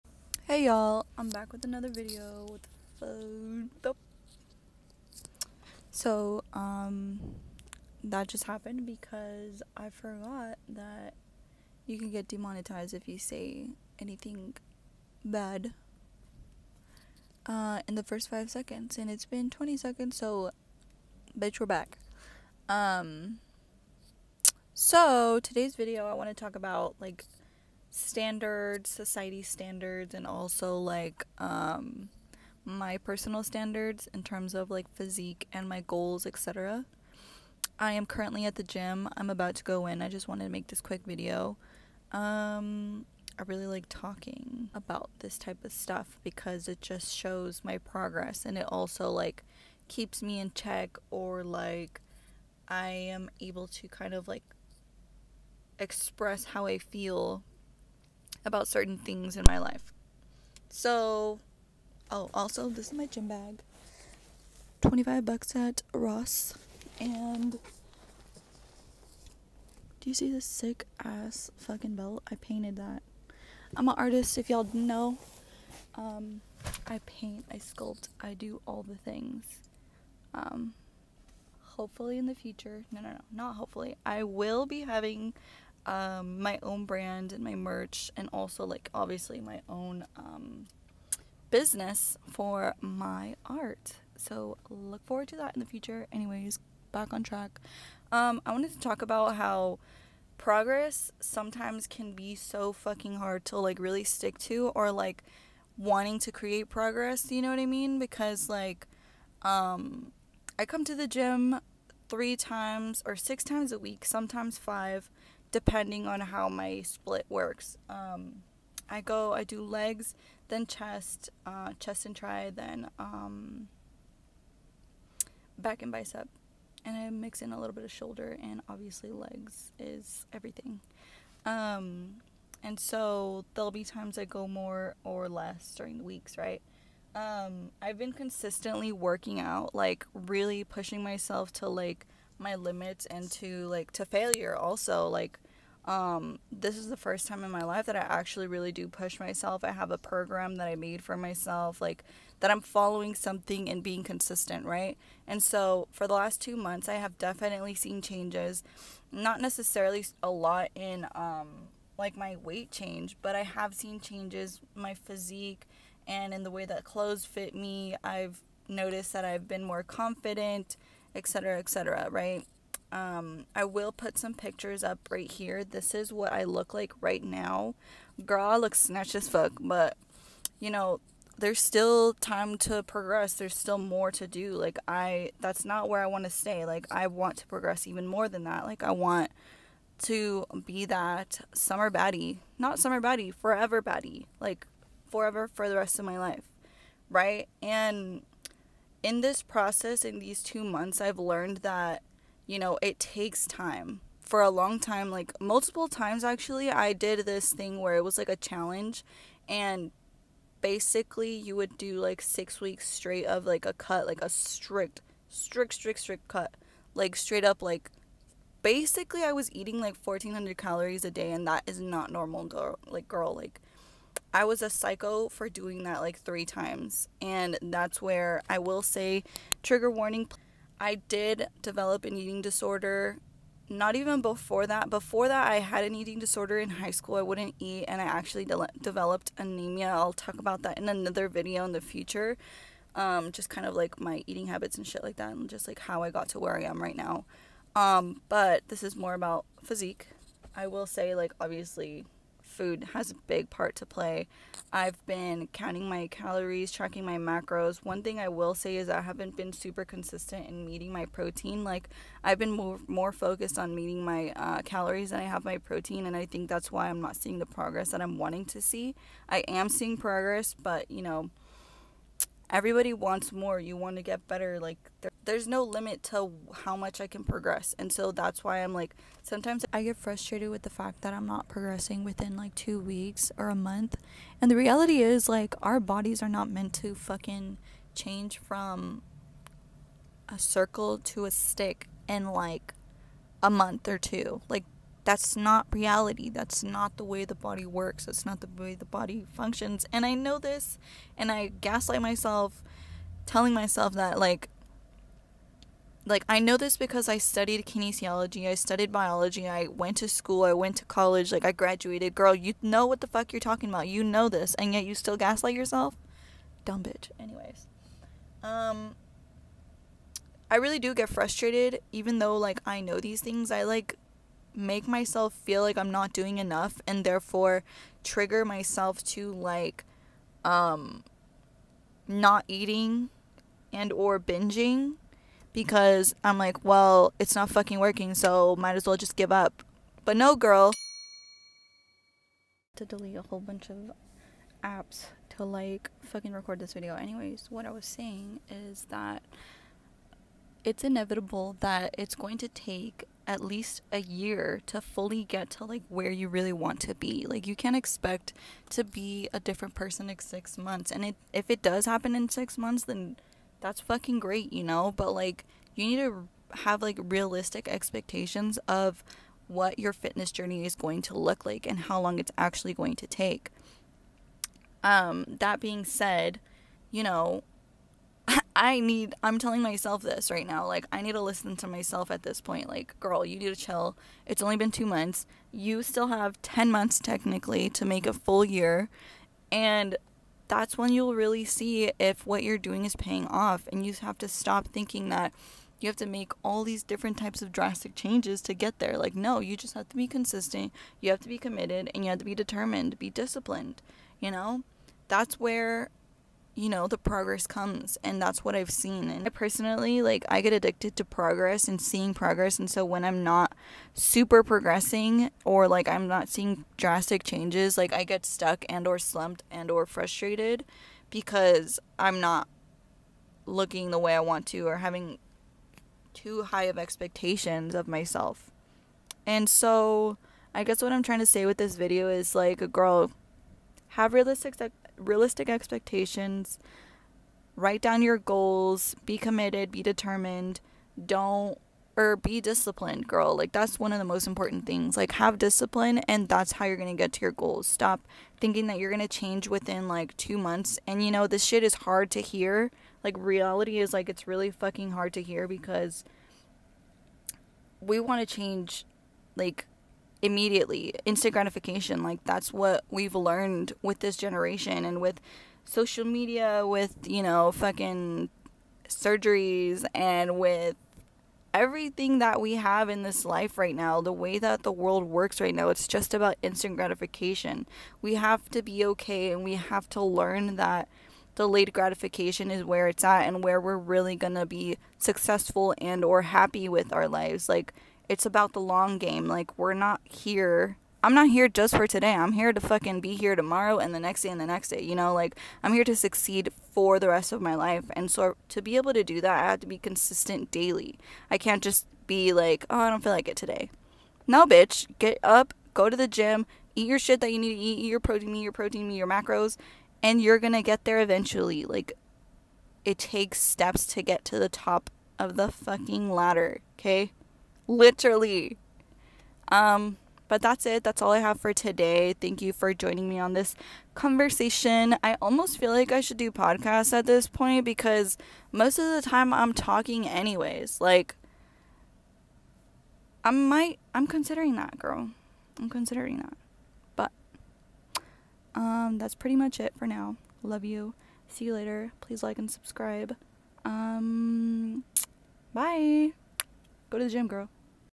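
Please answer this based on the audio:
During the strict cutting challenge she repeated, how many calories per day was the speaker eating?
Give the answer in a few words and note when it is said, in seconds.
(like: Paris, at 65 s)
1400, at 220 s.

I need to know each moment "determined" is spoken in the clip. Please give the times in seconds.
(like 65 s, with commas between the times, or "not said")
402 s, 439 s.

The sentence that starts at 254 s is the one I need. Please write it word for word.
I've been counting my calories, tracking my macros.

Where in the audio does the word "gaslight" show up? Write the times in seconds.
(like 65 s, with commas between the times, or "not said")
301 s, 315 s.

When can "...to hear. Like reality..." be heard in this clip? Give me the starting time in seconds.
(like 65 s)
452 s.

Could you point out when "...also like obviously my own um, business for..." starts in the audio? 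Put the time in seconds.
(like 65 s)
88 s.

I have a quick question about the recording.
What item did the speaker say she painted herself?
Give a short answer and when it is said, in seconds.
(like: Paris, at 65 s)
belt, at 71 s.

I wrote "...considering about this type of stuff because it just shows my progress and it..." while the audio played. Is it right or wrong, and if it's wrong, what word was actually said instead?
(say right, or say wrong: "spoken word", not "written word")
wrong: "talking", not "considering".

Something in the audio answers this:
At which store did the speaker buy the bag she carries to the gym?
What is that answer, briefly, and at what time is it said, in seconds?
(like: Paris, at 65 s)
Ross, at 65 s.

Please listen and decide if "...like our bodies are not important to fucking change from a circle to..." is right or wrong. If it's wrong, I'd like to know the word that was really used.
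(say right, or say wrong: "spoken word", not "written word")
wrong: "meant", not "important".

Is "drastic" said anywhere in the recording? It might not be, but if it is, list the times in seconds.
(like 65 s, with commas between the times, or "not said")
397 s, 416 s.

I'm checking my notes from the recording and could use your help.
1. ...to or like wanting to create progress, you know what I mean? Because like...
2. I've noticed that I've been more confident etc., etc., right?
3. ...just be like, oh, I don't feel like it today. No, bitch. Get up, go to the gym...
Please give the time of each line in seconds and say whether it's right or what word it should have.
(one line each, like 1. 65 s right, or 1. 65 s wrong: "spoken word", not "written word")
1. 104 s right
2. 168 s right
3. 501 s right.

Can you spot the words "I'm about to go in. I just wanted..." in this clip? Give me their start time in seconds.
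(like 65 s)
39 s.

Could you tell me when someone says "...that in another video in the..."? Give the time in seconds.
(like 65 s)
240 s.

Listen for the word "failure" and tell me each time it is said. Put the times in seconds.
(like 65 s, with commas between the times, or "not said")
144 s.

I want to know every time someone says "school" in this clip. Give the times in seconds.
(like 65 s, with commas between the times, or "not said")
236 s, 310 s.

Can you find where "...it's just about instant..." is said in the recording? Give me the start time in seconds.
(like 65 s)
475 s.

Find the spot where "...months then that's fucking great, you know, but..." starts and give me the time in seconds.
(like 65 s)
362 s.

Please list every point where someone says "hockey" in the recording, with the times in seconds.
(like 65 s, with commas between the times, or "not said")
not said.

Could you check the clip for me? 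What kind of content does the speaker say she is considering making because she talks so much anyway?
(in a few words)
podcasts.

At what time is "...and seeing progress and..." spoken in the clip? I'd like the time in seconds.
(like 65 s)
411 s.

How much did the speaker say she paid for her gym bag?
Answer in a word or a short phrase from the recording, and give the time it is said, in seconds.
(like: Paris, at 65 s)
$25, at 64 s.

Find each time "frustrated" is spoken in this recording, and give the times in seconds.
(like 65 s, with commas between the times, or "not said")
279 s, 321 s, 419 s.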